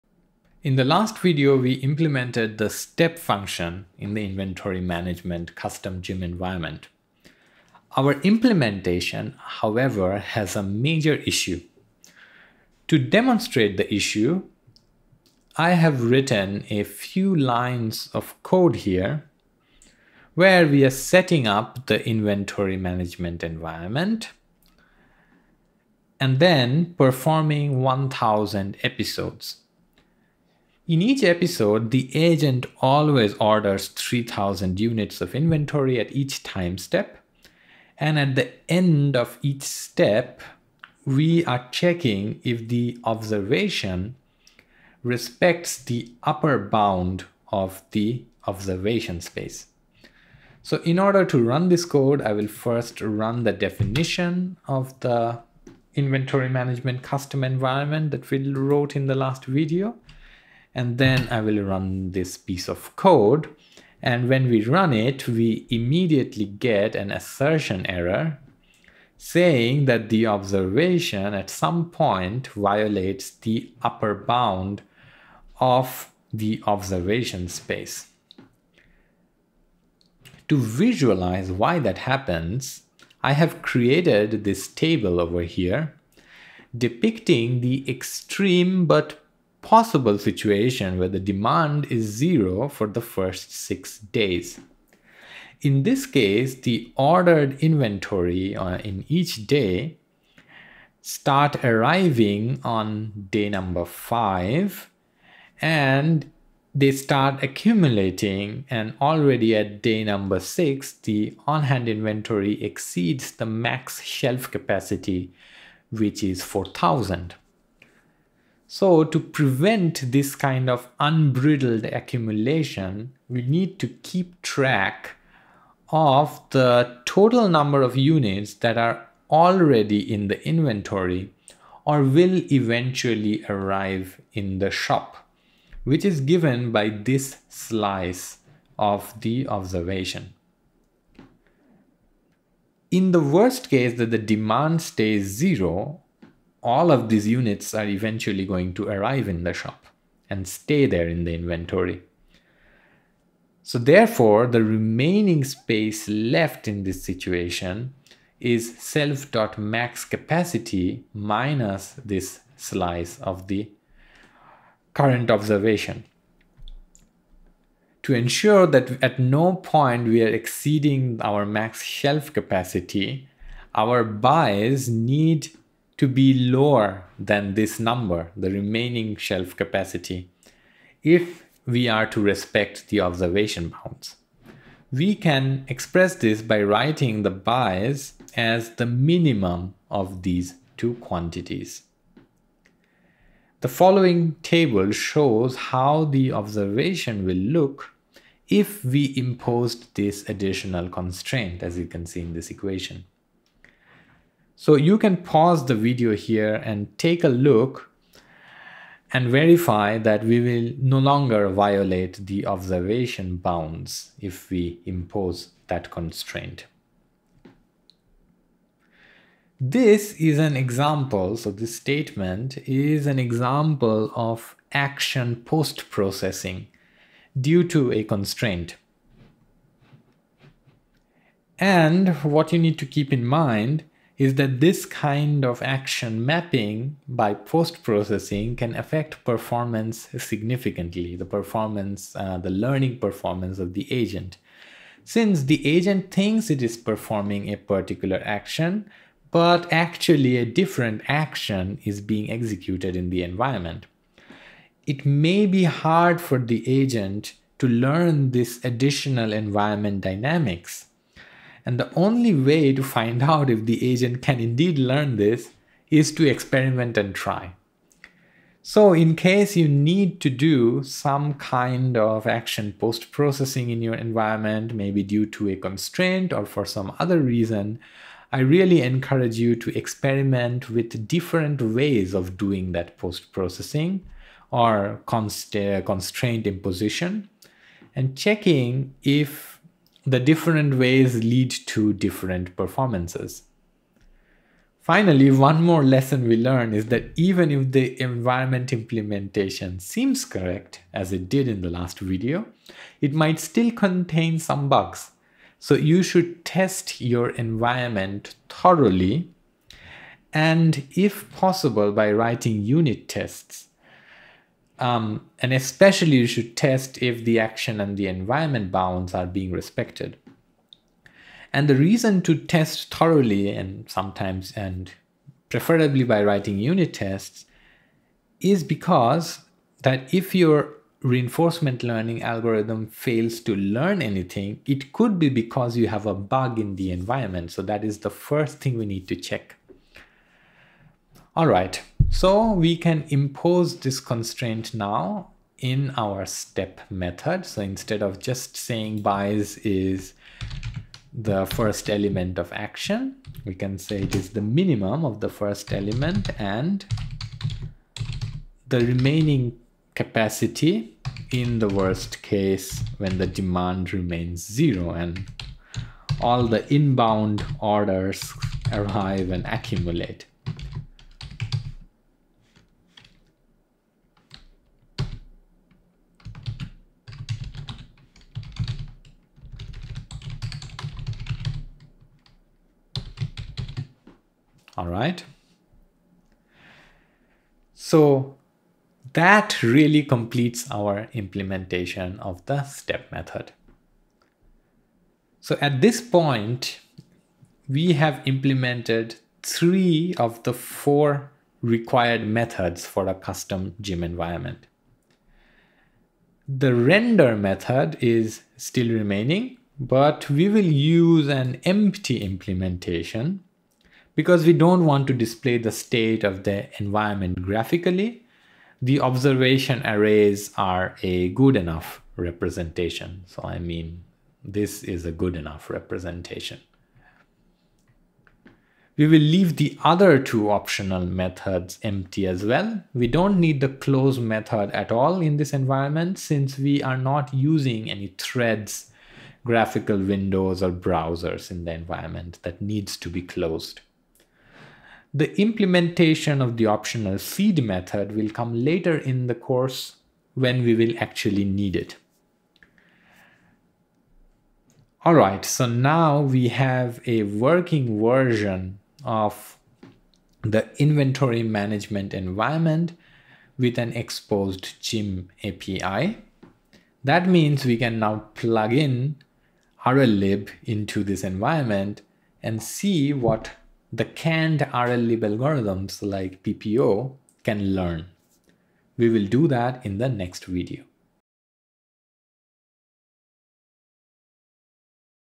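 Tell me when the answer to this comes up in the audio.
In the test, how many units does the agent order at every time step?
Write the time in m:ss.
0:33.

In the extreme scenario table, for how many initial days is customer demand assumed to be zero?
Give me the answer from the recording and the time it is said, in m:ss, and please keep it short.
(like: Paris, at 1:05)
6, at 1:33.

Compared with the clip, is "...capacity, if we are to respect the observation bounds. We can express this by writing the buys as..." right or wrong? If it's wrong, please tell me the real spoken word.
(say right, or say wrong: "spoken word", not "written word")
right.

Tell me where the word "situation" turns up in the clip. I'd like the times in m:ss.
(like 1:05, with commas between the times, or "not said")
1:30, 2:37.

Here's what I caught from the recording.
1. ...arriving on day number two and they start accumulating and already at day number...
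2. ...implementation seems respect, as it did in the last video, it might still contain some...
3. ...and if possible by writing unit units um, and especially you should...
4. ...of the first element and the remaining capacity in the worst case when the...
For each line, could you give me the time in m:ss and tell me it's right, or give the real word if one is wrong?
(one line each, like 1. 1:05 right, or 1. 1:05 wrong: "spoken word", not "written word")
1. 1:41 wrong: "five", not "two"
2. 4:58 wrong: "correct", not "respect"
3. 5:10 wrong: "tests", not "units"
4. 5:55 right.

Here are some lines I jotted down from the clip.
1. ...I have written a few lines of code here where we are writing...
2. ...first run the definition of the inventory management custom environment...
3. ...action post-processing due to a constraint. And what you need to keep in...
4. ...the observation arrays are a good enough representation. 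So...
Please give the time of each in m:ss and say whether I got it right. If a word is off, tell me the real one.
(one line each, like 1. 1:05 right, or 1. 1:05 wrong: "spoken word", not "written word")
1. 0:15 wrong: "setting", not "writing"
2. 0:52 right
3. 3:44 right
4. 6:58 right.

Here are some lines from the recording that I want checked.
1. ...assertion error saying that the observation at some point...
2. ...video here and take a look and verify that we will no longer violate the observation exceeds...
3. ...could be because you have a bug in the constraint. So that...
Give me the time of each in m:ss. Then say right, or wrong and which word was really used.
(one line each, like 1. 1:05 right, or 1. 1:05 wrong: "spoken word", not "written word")
1. 1:07 right
2. 3:25 wrong: "bounds", not "exceeds"
3. 5:34 wrong: "environment", not "constraint".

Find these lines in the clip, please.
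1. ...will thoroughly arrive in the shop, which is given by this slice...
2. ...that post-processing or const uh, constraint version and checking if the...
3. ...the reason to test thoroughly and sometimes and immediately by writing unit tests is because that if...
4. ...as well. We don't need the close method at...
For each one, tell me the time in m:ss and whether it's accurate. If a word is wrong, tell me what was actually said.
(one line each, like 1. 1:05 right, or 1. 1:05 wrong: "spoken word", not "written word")
1. 2:12 wrong: "eventually", not "thoroughly"
2. 4:42 wrong: "imposition", not "version"
3. 5:21 wrong: "preferably", not "immediately"
4. 7:12 right.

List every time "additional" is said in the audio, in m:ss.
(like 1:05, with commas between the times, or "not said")
3:20, 4:18.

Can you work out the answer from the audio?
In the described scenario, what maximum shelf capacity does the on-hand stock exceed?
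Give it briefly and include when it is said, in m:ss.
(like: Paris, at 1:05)
4000, at 1:56.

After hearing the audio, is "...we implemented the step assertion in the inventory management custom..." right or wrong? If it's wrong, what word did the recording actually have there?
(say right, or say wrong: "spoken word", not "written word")
wrong: "function", not "assertion".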